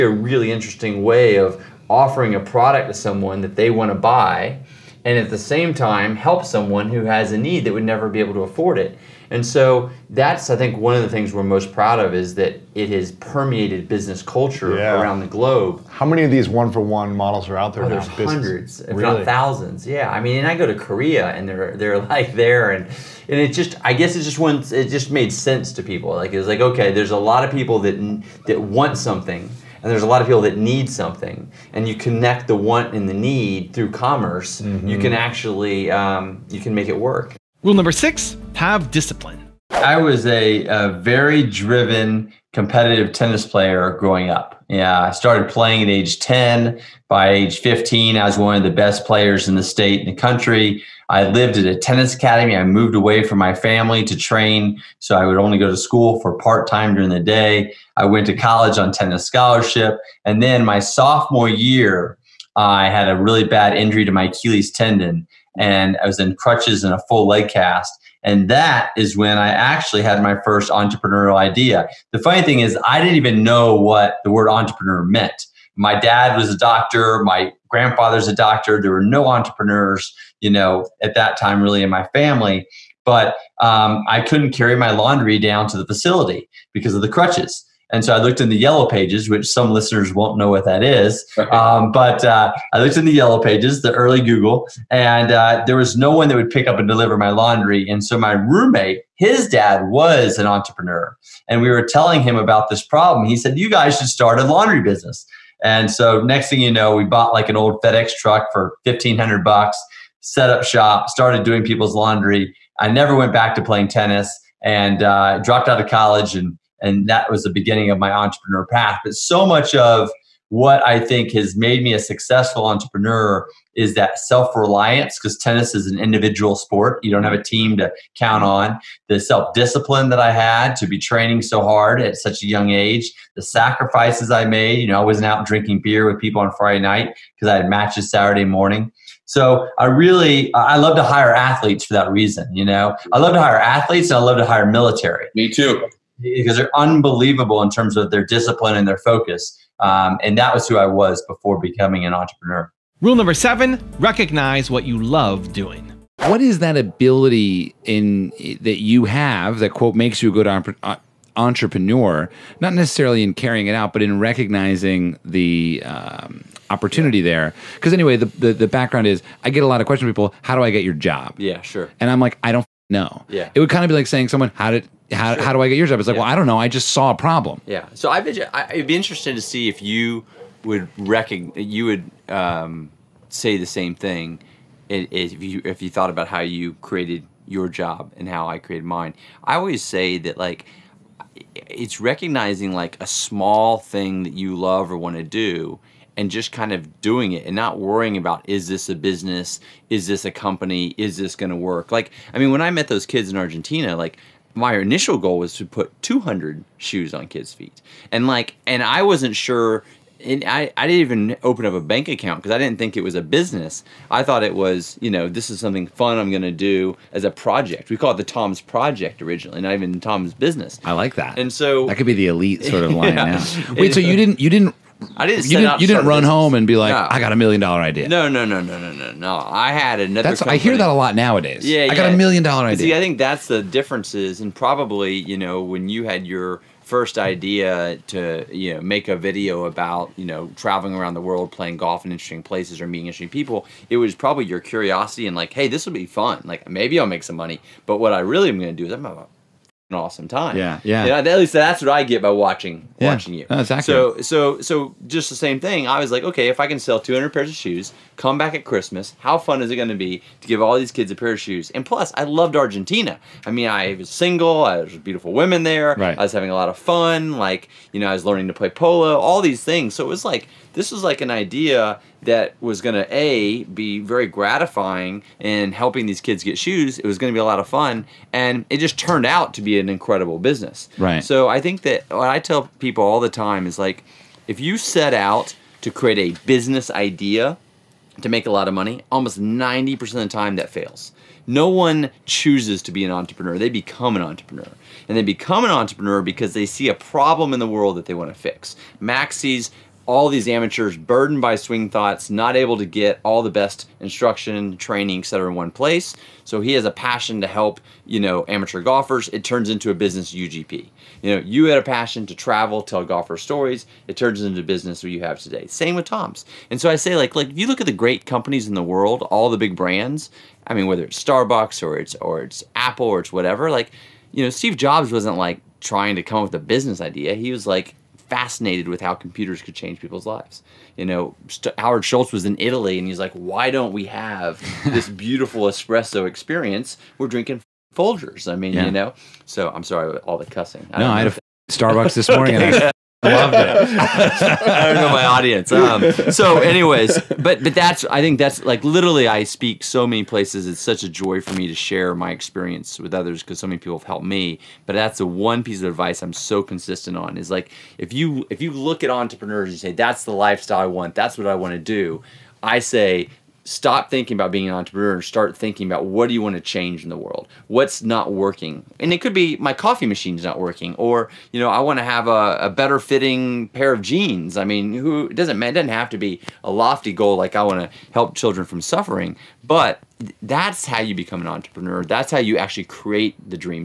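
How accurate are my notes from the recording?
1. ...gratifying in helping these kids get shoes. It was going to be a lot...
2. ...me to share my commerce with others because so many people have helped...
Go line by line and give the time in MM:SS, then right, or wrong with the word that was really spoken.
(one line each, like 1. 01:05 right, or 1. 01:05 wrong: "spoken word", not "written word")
1. 04:34 right
2. 05:51 wrong: "experience", not "commerce".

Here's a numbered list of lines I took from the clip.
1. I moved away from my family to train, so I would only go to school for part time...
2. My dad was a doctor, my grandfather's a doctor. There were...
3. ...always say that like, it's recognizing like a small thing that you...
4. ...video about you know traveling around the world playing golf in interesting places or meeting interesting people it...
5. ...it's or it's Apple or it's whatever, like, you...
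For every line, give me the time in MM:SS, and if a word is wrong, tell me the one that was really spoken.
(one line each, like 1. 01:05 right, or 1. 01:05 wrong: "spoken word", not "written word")
1. 00:52 right
2. 01:15 right
3. 03:09 right
4. 03:59 right
5. 05:21 right.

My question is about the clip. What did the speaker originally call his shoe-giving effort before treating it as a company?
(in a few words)
The Tom's Project.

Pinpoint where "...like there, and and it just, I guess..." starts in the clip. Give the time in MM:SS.
00:21.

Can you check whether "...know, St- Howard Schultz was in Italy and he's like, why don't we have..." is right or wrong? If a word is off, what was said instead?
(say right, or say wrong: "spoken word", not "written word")
right.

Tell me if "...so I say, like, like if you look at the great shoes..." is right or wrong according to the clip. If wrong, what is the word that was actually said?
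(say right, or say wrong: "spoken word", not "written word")
wrong: "companies", not "shoes".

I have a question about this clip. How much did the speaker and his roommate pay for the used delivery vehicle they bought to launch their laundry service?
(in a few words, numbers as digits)
$1500.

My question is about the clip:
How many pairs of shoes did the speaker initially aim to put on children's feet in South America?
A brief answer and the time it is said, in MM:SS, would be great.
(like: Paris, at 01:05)
200, at 03:26.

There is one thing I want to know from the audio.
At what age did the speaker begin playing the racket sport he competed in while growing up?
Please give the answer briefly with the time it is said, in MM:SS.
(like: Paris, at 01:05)
10, at 00:45.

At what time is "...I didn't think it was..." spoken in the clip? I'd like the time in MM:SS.
03:32.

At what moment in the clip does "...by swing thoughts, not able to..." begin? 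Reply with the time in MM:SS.
05:01.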